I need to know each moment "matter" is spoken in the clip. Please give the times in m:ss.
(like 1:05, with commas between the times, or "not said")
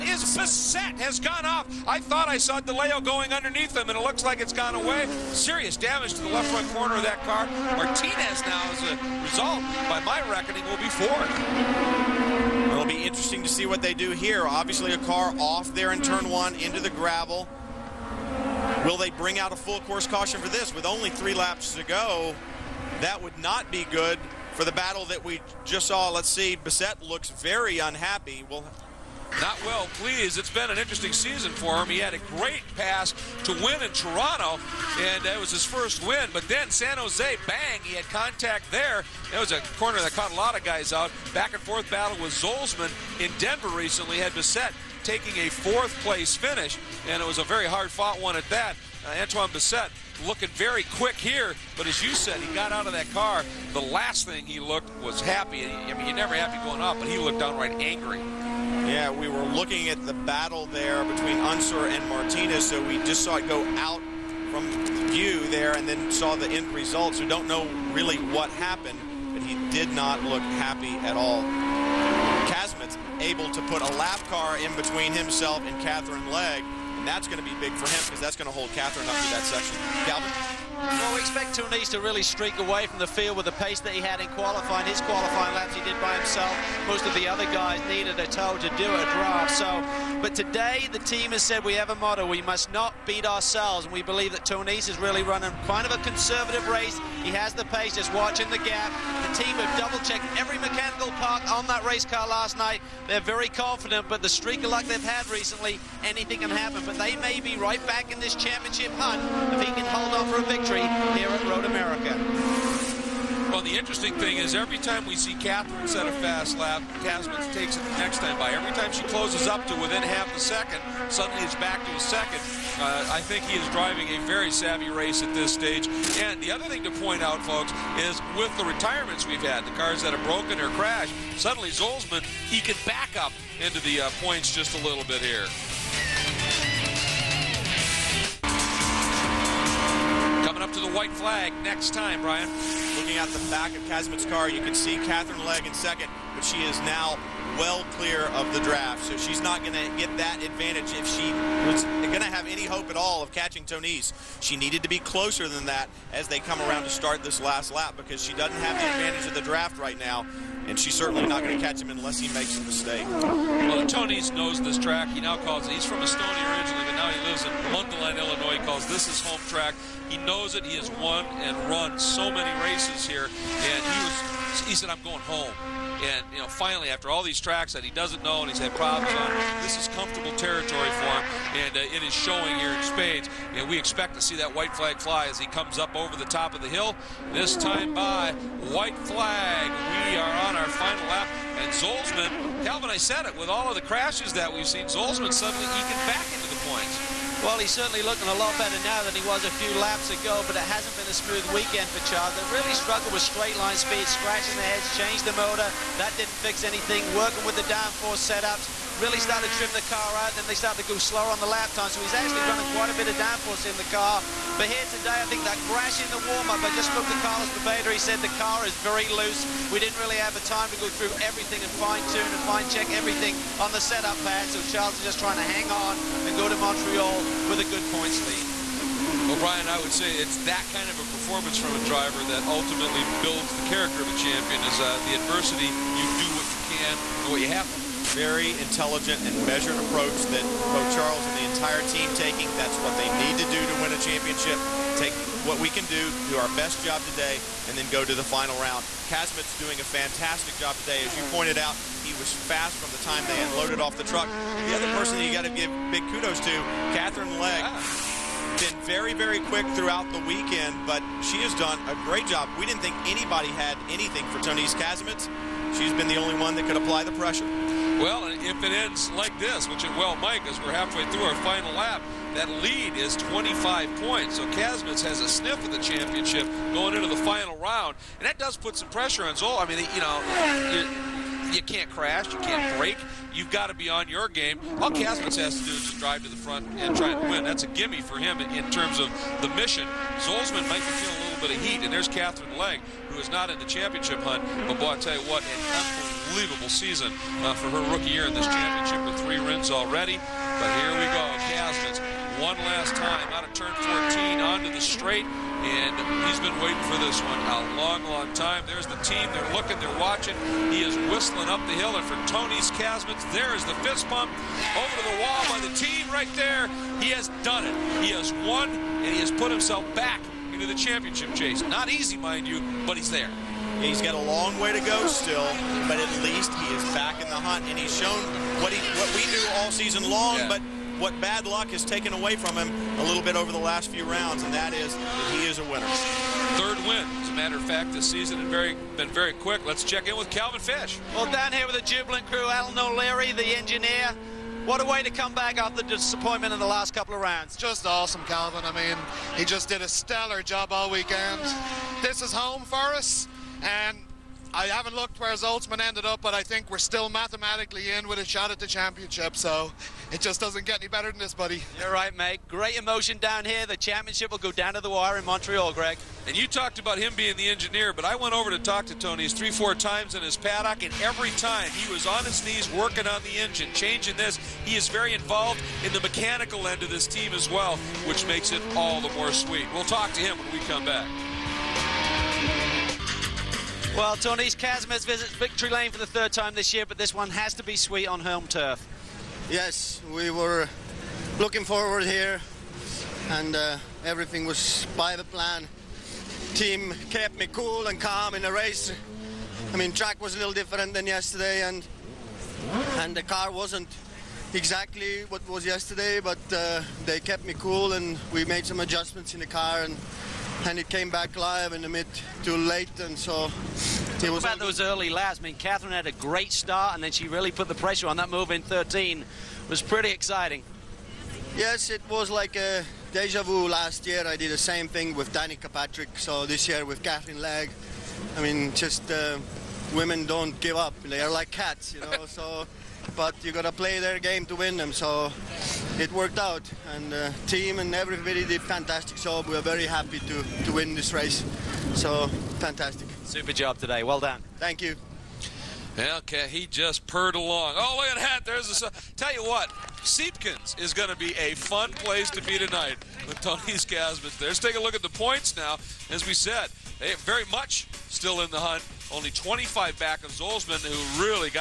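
5:37.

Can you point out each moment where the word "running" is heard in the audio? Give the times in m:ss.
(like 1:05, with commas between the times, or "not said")
1:35, 3:32.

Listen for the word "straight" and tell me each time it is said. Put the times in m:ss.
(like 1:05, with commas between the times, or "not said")
3:23, 5:04.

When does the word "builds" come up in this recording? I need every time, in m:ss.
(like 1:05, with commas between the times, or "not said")
3:53.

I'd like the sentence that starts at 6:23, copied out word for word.
Well, Tõnis Kasemets visits Victory Lane for the third time this year, but this one has to be sweet on home turf.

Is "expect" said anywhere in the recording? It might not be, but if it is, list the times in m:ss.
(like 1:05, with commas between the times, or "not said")
1:21, 3:03.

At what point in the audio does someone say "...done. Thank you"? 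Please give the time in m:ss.
7:24.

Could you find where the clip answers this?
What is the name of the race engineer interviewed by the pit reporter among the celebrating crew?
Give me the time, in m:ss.
5:42.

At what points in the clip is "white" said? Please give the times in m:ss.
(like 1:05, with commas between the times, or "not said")
2:20, 3:04, 3:08.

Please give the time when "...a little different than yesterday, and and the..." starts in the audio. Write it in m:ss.
6:40.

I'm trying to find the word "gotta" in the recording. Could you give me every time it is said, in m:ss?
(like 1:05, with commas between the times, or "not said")
7:13.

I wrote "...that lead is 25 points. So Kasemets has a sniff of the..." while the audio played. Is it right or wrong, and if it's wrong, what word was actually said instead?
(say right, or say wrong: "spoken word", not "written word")
right.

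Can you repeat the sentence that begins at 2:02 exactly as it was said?
Uh, I think he is driving a very savvy race at this stage.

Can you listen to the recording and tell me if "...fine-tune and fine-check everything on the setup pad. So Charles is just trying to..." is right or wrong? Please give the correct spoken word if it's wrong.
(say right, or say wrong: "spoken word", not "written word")
right.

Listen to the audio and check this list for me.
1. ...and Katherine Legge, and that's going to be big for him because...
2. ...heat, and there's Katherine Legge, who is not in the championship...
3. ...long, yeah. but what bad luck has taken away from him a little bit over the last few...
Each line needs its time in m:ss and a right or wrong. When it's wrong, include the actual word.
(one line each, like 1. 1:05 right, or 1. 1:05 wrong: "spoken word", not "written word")
1. 1:15 right
2. 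4:51 right
3. 5:30 right.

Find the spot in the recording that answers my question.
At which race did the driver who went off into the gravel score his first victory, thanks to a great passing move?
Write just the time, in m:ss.
0:33.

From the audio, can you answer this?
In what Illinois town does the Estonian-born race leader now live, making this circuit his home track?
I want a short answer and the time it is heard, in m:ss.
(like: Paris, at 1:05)
Mundelein, at 2:47.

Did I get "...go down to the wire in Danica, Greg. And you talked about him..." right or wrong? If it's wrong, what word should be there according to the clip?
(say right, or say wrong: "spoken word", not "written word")
wrong: "Montreal", not "Danica".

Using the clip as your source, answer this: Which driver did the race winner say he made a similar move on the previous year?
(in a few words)
Danica Patrick.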